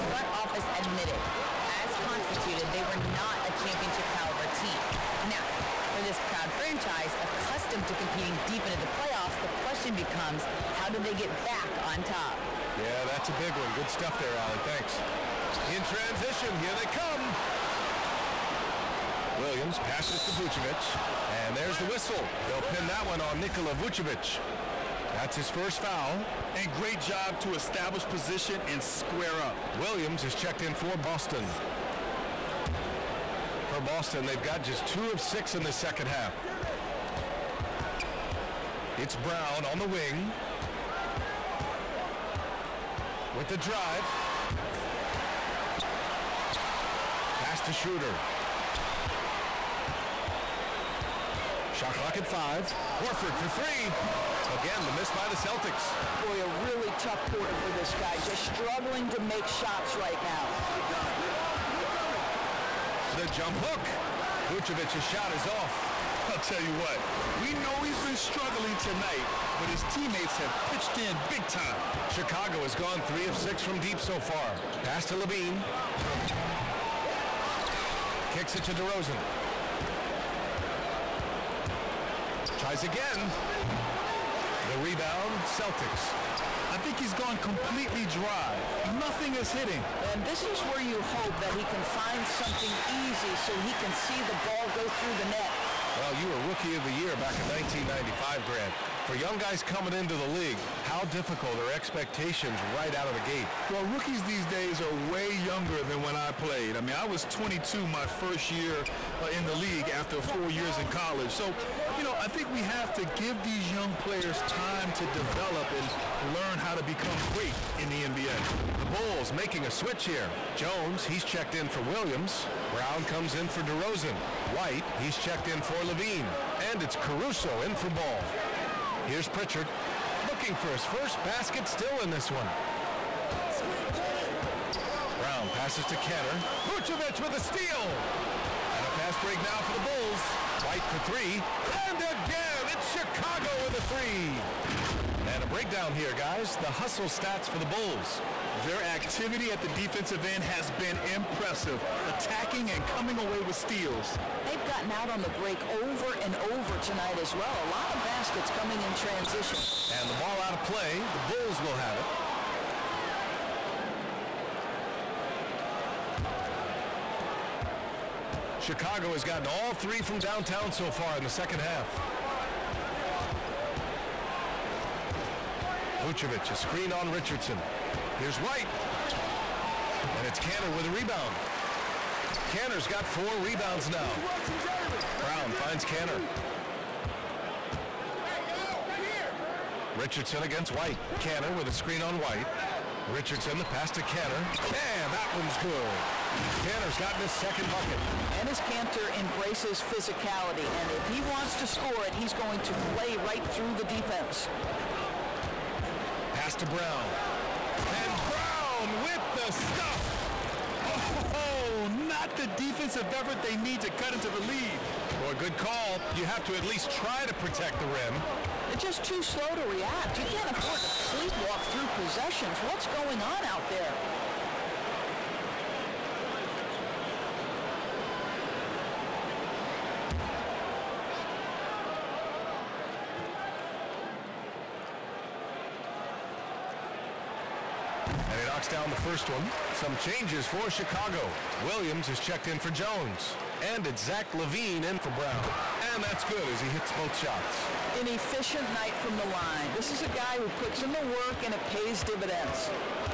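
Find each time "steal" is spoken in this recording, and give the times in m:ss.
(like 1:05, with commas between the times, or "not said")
2:17, 2:33.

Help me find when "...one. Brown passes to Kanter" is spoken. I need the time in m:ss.
2:12.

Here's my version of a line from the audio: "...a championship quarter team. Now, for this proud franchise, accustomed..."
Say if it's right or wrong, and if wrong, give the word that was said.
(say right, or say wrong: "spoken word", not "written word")
wrong: "caliber", not "quarter".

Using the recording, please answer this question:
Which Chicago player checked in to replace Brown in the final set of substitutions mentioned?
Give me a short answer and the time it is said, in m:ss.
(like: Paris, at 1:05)
Zach LaVine, at 4:04.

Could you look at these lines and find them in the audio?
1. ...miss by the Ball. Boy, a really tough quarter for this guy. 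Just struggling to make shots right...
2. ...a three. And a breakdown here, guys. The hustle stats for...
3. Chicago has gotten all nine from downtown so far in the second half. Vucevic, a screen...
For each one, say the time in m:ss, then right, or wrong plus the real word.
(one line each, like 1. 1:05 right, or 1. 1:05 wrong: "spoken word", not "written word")
1. 0:54 wrong: "Celtics", not "Ball"
2. 2:23 right
3. 2:48 wrong: "three", not "nine".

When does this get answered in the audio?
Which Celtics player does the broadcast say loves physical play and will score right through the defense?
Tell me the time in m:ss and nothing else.
3:18.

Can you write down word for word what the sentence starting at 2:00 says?
Jones, he's checked in for Williams.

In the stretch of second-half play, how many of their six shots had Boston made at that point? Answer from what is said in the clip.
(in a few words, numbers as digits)
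2.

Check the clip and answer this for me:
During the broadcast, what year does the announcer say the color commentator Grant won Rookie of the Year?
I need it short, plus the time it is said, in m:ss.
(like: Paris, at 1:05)
1995, at 1:37.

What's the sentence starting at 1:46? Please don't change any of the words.
I mean, I was 22 my first year uh, in the league after four years in college.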